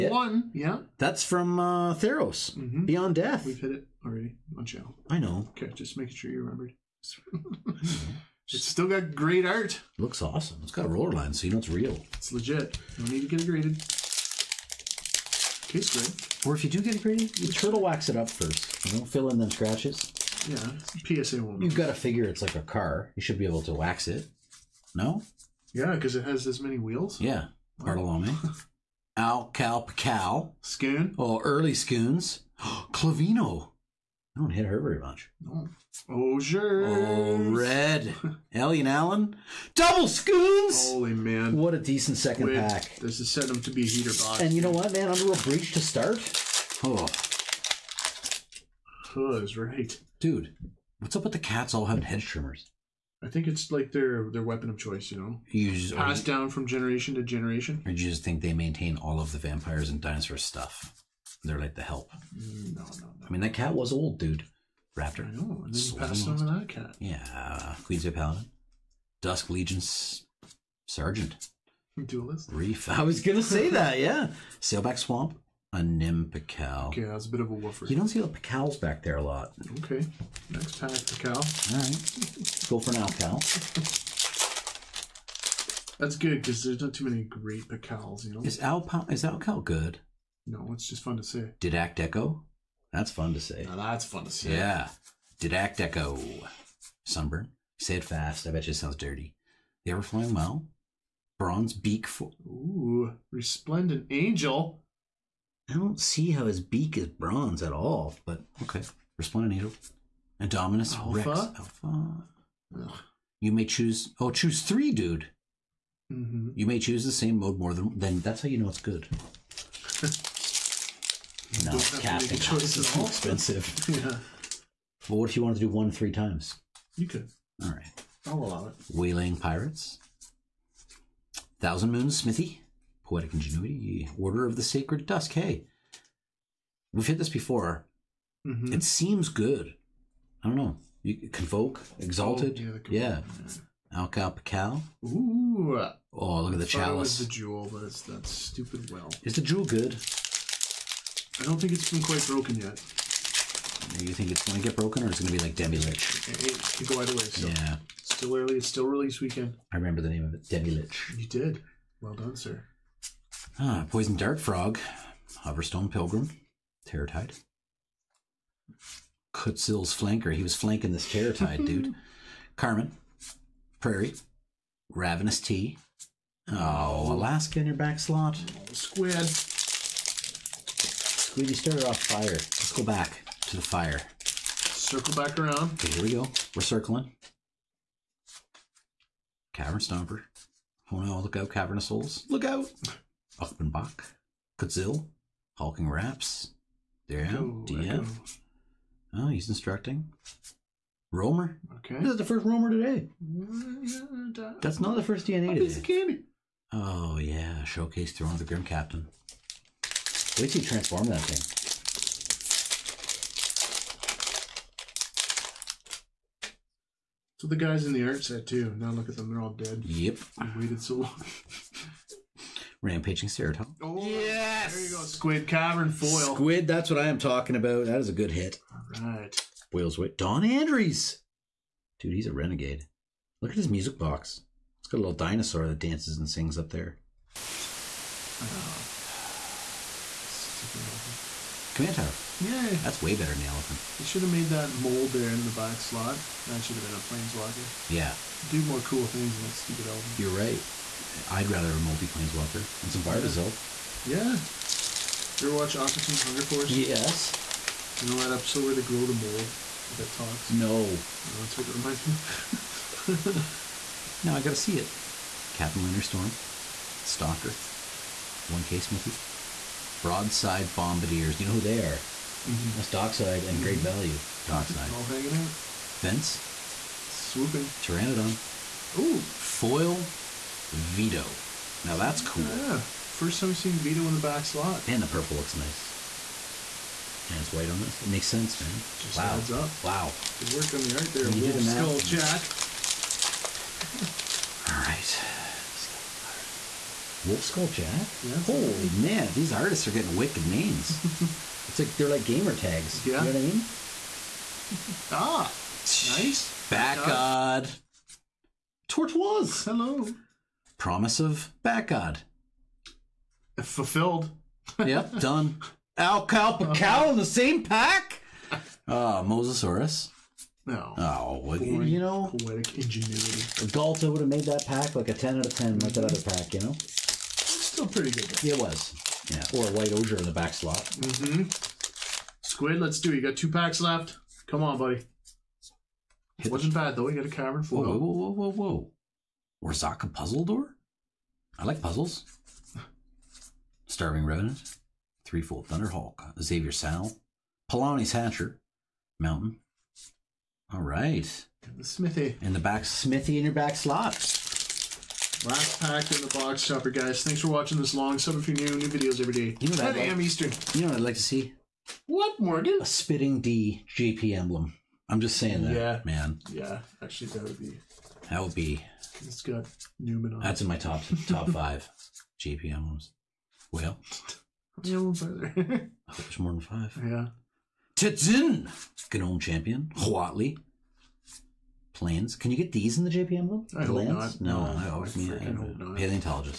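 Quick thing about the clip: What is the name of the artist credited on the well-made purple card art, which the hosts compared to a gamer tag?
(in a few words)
Wolf Skull Jack.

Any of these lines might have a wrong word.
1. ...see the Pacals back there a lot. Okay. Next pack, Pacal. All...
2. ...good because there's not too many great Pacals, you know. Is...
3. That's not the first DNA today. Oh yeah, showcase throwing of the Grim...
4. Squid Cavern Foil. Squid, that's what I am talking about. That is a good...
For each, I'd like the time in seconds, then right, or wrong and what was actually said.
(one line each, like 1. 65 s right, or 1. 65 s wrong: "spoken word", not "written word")
1. 78 s right
2. 86 s right
3. 204 s right
4. 225 s right.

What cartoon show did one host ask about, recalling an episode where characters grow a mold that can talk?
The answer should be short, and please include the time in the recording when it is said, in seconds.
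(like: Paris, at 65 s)
Octopus Hunger Force, at 255 s.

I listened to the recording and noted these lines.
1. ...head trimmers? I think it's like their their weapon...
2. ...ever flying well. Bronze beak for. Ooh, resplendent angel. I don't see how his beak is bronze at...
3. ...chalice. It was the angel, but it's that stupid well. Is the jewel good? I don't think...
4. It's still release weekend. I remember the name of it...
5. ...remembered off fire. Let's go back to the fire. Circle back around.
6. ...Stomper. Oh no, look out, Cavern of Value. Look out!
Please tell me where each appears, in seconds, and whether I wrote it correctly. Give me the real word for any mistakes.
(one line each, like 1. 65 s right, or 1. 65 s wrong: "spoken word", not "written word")
1. 52 s right
2. 99 s right
3. 146 s wrong: "jewel", not "angel"
4. 158 s right
5. 181 s wrong: "started", not "remembered"
6. 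189 s wrong: "Souls", not "Value".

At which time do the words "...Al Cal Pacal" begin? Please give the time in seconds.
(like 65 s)
29 s.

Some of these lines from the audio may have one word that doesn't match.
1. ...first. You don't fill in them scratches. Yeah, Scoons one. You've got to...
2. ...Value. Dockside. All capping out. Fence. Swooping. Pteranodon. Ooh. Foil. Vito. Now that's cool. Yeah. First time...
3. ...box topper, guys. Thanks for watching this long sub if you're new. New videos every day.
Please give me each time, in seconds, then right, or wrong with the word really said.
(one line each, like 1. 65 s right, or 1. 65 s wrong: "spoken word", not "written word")
1. 18 s wrong: "PSA", not "Scoons"
2. 273 s wrong: "hanging", not "capping"
3. 356 s right.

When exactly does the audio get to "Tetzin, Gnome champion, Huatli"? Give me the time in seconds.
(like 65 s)
377 s.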